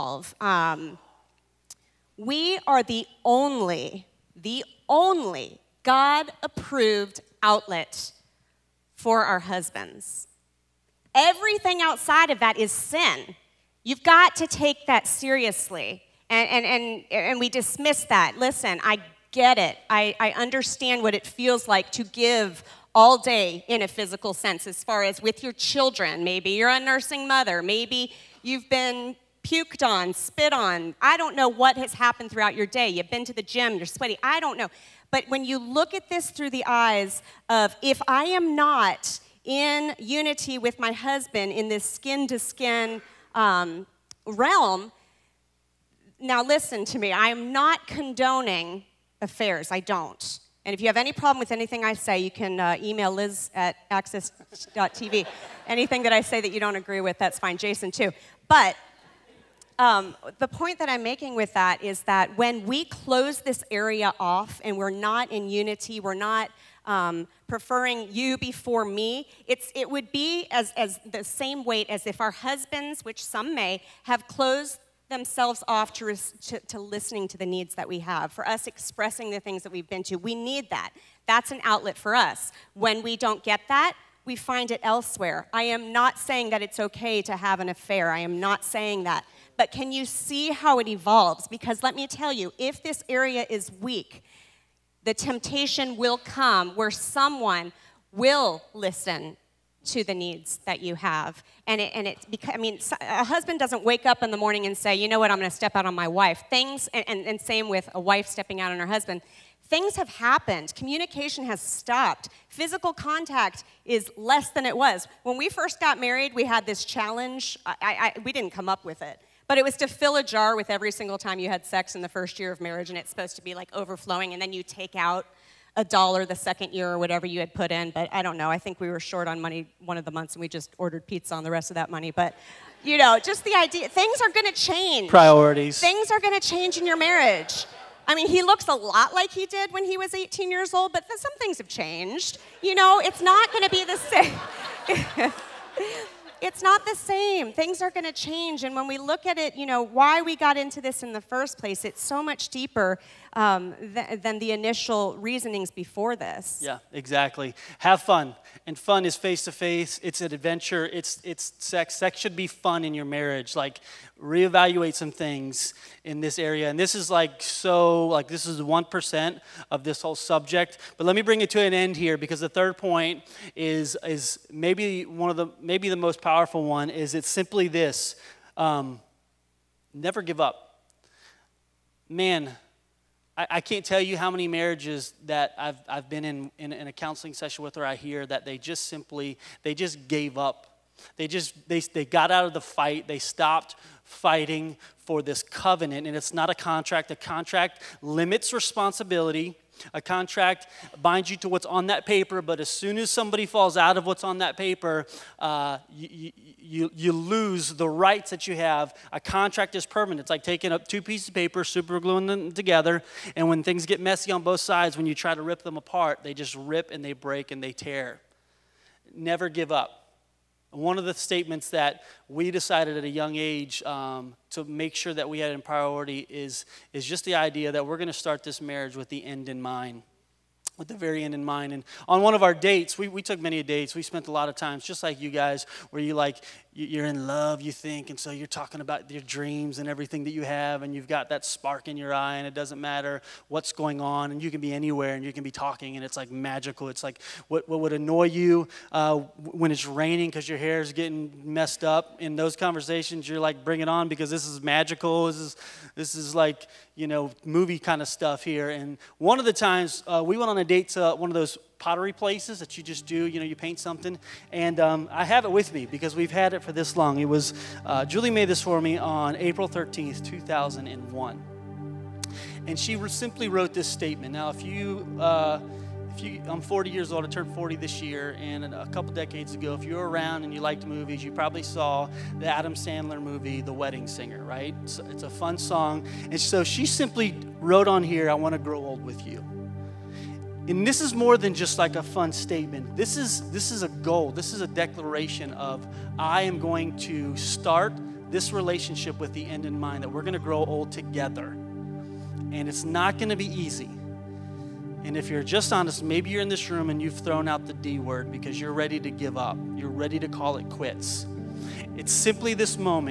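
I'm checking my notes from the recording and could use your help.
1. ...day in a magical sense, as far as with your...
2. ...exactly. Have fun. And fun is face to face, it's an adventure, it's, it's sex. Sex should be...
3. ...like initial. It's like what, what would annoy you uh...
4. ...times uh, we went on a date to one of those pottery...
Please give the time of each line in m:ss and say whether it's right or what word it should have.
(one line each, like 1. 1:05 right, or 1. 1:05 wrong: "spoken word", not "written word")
1. 0:23 wrong: "physical", not "magical"
2. 2:36 right
3. 4:06 wrong: "magical", not "initial"
4. 4:19 right.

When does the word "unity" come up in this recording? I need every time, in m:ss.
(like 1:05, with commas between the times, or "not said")
0:39, 1:05.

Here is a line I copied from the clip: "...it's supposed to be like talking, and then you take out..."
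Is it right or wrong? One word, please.
wrong.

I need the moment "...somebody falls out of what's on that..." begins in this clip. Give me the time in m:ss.
3:23.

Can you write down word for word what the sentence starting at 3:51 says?
And on one of our dates, we, we took many dates.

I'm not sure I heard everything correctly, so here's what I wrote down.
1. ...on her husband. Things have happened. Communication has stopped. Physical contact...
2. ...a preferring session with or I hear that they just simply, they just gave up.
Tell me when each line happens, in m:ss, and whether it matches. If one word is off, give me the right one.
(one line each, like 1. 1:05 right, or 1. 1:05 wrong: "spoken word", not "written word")
1. 1:48 right
2. 3:06 wrong: "counseling", not "preferring".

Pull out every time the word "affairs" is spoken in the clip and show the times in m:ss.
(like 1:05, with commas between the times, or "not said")
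0:49, 1:27.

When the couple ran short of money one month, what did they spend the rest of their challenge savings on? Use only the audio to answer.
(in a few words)
pizza.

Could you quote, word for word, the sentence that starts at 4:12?
In those conversations, you're like, bring it on because this is magical.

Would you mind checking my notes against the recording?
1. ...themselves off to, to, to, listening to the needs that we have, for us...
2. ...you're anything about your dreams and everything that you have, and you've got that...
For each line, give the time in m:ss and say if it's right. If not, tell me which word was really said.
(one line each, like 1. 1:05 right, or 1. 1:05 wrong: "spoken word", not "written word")
1. 1:15 right
2. 3:58 wrong: "talking", not "anything".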